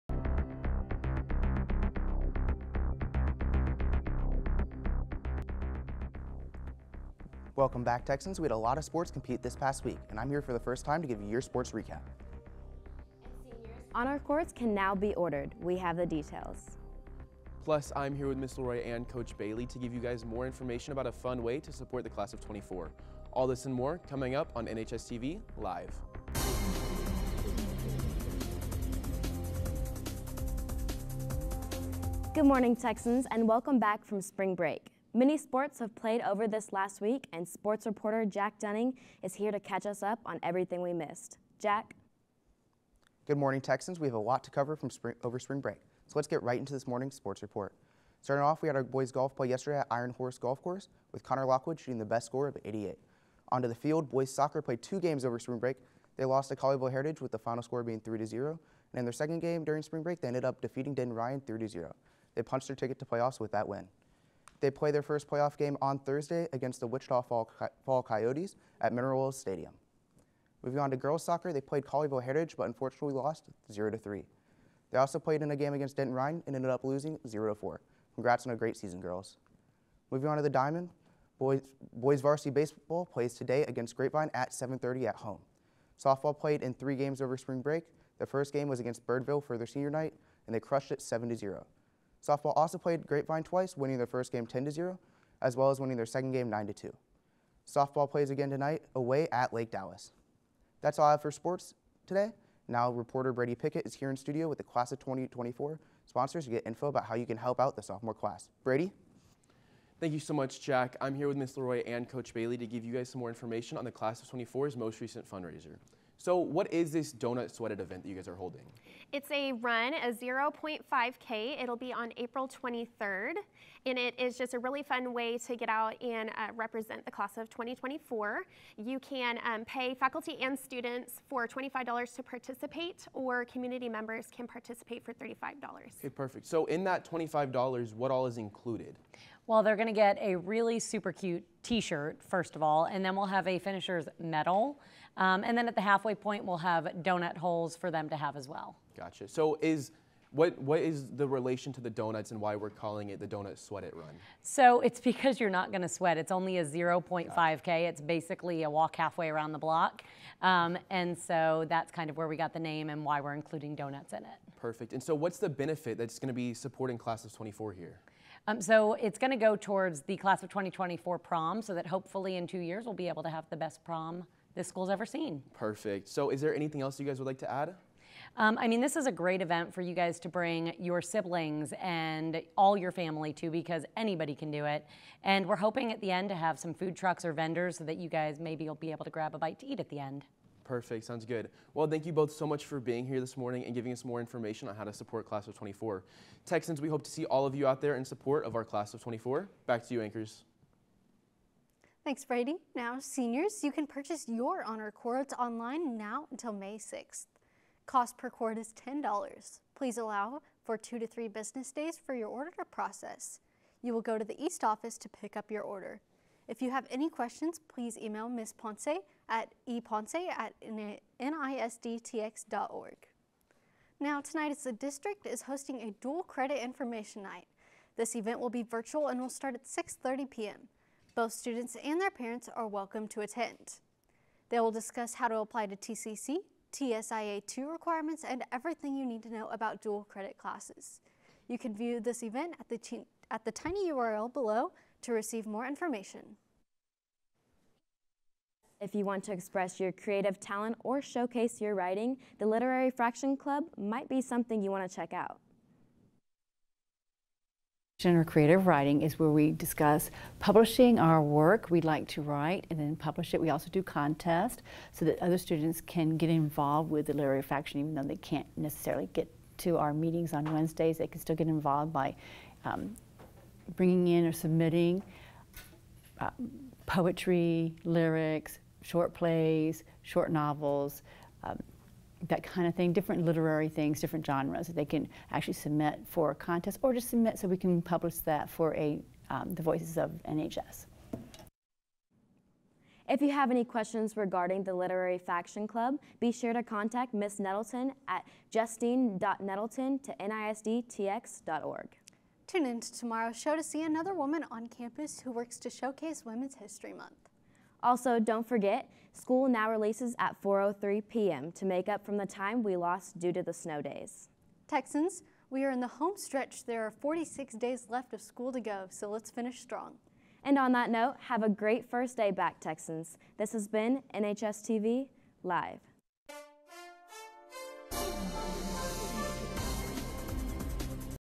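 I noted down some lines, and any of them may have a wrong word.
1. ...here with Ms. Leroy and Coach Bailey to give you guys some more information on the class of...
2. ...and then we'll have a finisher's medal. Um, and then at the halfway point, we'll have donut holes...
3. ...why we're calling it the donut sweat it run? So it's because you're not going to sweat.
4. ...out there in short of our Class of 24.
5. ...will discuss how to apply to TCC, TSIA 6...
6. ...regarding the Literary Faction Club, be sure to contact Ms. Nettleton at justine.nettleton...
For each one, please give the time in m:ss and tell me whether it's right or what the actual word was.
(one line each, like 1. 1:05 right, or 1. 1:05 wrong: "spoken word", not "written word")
1. 1:51 right
2. 2:22 right
3. 2:32 right
4. 3:17 wrong: "support", not "short"
5. 3:54 wrong: "2", not "6"
6. 4:54 right.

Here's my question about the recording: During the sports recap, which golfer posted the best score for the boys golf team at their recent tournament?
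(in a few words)
Connor Lockwood.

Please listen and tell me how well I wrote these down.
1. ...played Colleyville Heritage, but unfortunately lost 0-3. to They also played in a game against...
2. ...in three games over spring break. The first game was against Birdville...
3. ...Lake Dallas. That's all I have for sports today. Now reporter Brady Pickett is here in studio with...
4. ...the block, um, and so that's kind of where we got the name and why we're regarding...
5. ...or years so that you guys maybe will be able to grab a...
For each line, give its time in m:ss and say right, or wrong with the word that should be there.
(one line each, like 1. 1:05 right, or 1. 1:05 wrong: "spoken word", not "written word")
1. 1:11 right
2. 1:26 right
3. 1:39 right
4. 2:39 wrong: "including", not "regarding"
5. 3:07 wrong: "vendors", not "years".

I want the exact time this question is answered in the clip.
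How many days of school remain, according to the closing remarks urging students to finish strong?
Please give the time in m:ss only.
5:16.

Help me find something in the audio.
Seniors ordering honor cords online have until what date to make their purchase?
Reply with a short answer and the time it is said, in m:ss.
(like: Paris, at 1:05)
May 6, at 3:26.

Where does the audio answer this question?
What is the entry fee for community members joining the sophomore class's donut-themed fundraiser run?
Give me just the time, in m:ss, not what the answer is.
2:15.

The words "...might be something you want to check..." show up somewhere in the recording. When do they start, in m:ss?
4:13.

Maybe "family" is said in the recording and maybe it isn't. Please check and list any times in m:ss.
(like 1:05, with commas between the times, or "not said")
3:02.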